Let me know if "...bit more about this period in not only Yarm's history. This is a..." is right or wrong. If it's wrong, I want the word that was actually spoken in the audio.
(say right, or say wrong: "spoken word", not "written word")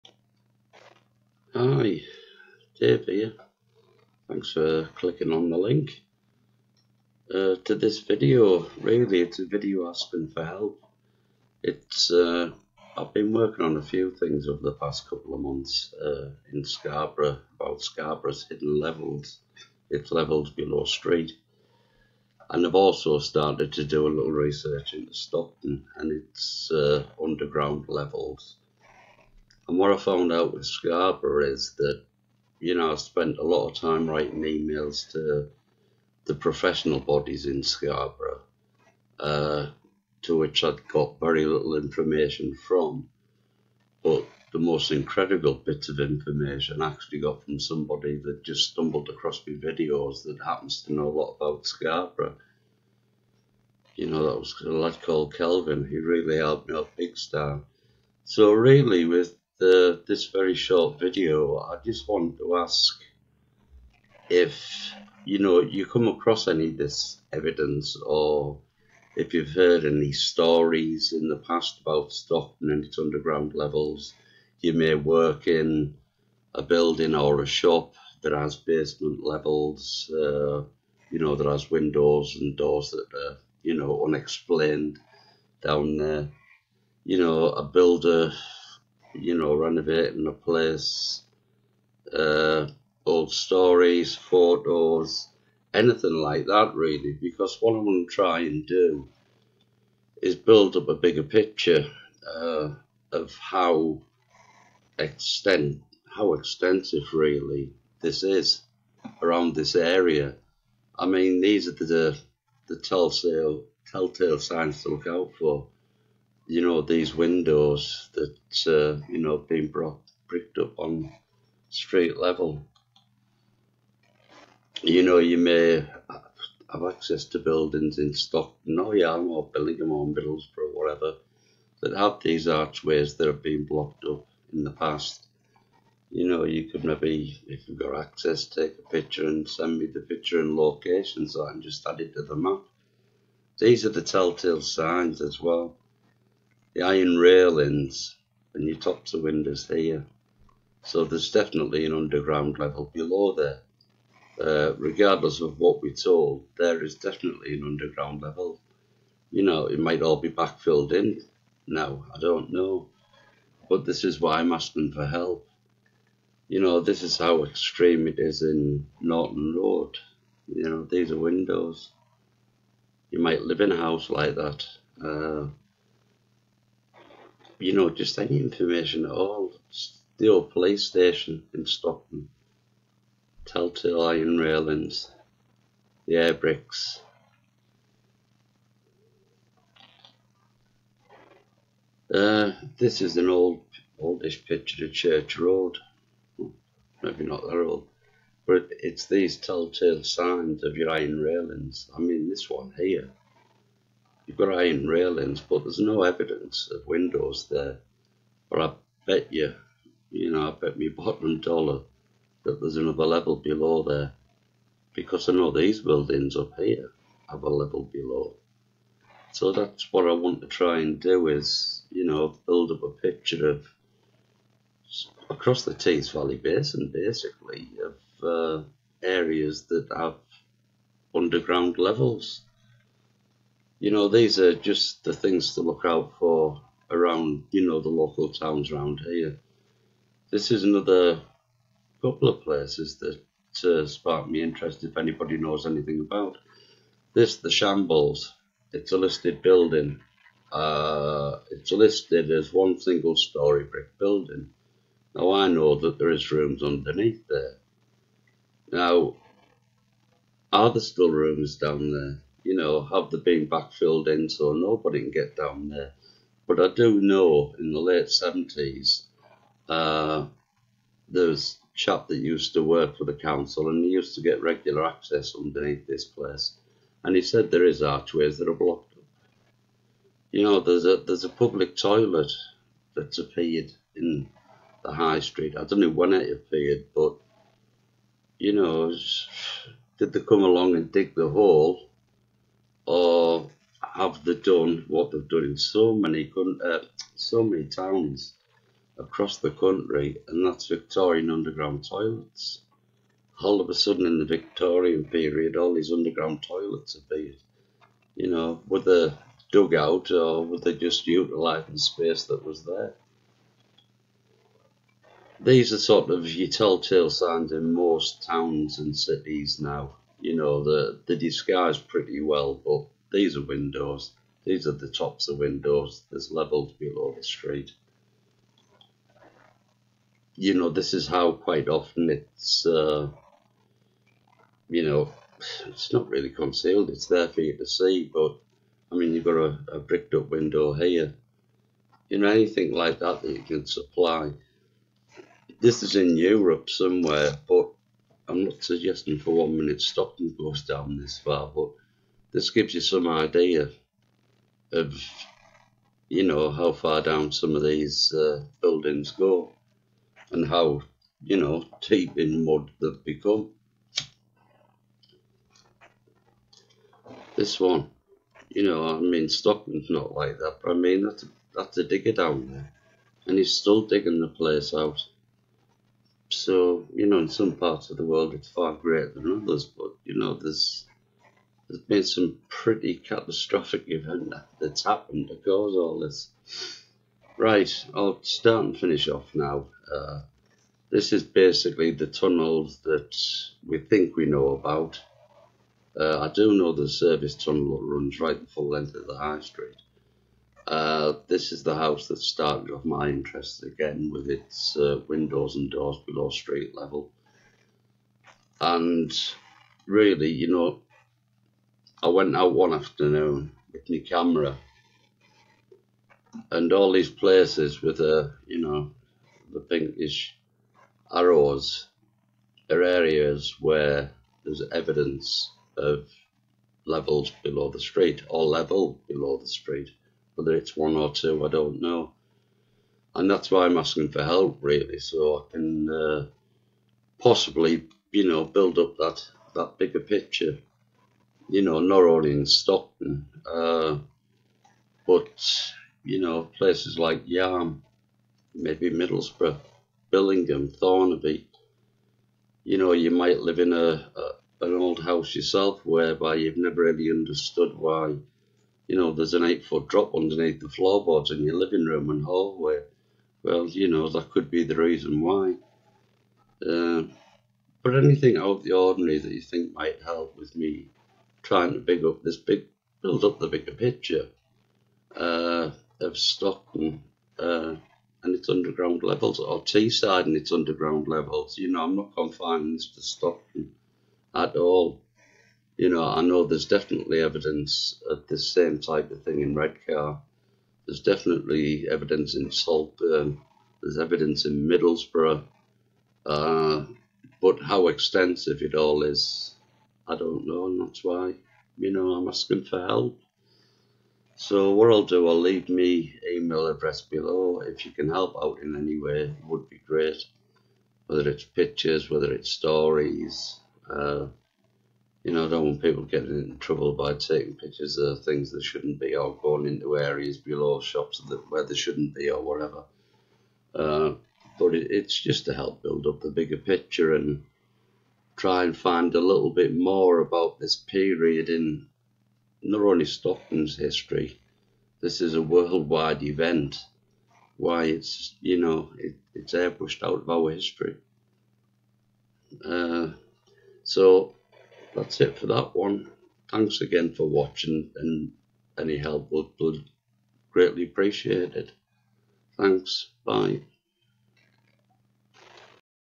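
wrong: "Stockton", not "Yarm".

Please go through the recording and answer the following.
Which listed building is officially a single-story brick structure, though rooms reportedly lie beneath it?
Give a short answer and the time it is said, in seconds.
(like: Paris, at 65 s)
The Shambles, at 247 s.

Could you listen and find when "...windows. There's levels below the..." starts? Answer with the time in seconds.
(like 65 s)
325 s.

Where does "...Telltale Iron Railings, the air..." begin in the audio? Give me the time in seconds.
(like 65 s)
183 s.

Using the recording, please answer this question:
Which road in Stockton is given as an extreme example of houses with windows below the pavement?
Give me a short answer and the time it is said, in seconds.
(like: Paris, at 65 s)
Norton Road, at 168 s.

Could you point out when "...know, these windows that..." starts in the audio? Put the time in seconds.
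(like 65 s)
116 s.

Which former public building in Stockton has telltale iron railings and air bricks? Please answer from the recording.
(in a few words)
The old police station.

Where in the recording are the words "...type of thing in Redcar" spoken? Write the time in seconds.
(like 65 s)
488 s.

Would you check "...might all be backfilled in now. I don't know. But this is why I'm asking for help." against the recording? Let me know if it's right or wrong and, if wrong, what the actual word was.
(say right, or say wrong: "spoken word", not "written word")
right.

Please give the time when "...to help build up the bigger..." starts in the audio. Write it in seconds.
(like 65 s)
525 s.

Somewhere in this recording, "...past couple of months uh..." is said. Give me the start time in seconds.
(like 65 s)
14 s.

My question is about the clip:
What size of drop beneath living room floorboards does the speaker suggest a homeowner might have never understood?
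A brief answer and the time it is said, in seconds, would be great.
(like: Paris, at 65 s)
8 feet, at 459 s.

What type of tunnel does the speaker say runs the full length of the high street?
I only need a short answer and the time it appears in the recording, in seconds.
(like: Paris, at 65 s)
Service tunnel, at 396 s.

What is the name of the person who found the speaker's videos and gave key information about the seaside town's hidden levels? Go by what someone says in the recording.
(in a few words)
Kelvin.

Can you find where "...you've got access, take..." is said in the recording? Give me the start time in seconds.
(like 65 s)
137 s.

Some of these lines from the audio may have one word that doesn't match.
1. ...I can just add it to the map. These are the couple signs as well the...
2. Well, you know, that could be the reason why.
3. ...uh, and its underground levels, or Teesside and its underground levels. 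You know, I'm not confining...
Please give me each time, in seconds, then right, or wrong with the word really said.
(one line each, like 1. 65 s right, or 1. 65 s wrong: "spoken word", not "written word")
1. 141 s wrong: "telltale", not "couple"
2. 463 s right
3. 477 s right.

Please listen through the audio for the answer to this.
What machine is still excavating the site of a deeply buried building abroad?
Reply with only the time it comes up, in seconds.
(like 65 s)
371 s.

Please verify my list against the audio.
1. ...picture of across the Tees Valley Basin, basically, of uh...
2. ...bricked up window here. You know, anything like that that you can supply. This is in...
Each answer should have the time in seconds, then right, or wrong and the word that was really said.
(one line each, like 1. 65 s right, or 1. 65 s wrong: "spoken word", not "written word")
1. 222 s right
2. 339 s right.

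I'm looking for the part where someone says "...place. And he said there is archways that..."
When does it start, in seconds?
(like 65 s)
276 s.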